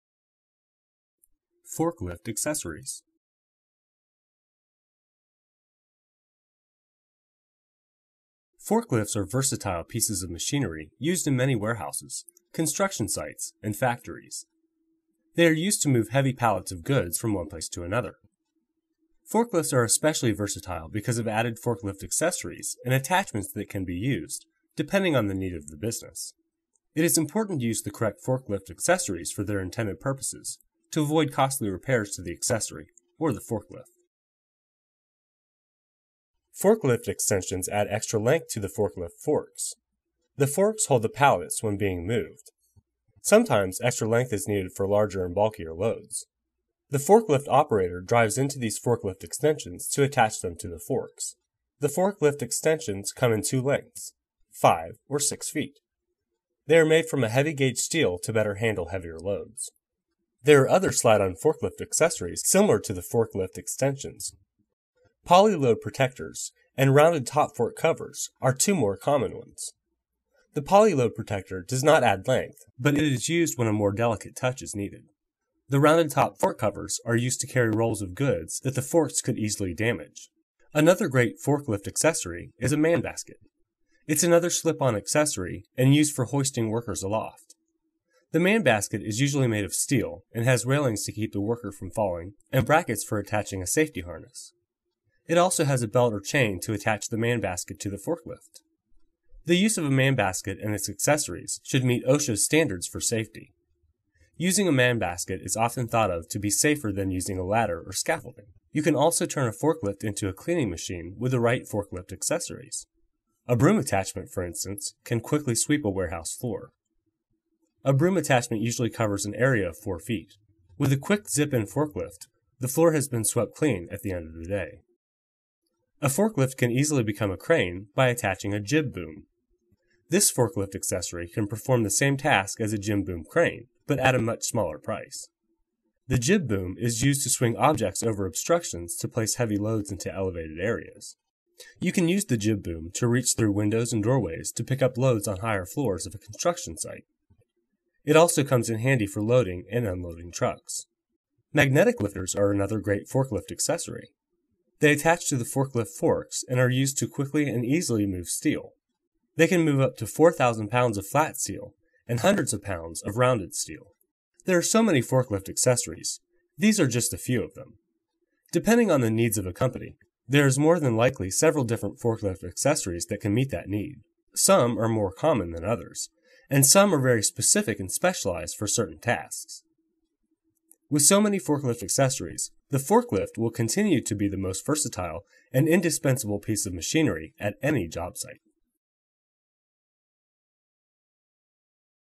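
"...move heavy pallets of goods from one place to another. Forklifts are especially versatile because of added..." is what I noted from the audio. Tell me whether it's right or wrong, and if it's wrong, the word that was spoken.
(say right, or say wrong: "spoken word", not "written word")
right.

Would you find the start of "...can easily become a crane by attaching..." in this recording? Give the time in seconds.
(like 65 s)
126 s.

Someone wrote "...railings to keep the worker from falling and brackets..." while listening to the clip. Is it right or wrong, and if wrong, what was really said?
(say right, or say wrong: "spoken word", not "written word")
right.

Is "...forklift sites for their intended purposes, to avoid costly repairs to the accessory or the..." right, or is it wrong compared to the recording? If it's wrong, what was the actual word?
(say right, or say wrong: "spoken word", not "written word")
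wrong: "accessories", not "sites".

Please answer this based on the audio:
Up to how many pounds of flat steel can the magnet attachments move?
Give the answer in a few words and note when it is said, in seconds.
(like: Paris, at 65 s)
4,000 pounds, at 160 s.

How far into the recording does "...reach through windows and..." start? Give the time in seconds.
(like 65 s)
143 s.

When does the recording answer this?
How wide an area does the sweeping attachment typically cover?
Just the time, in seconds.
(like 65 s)
119 s.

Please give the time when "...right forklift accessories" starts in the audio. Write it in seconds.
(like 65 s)
111 s.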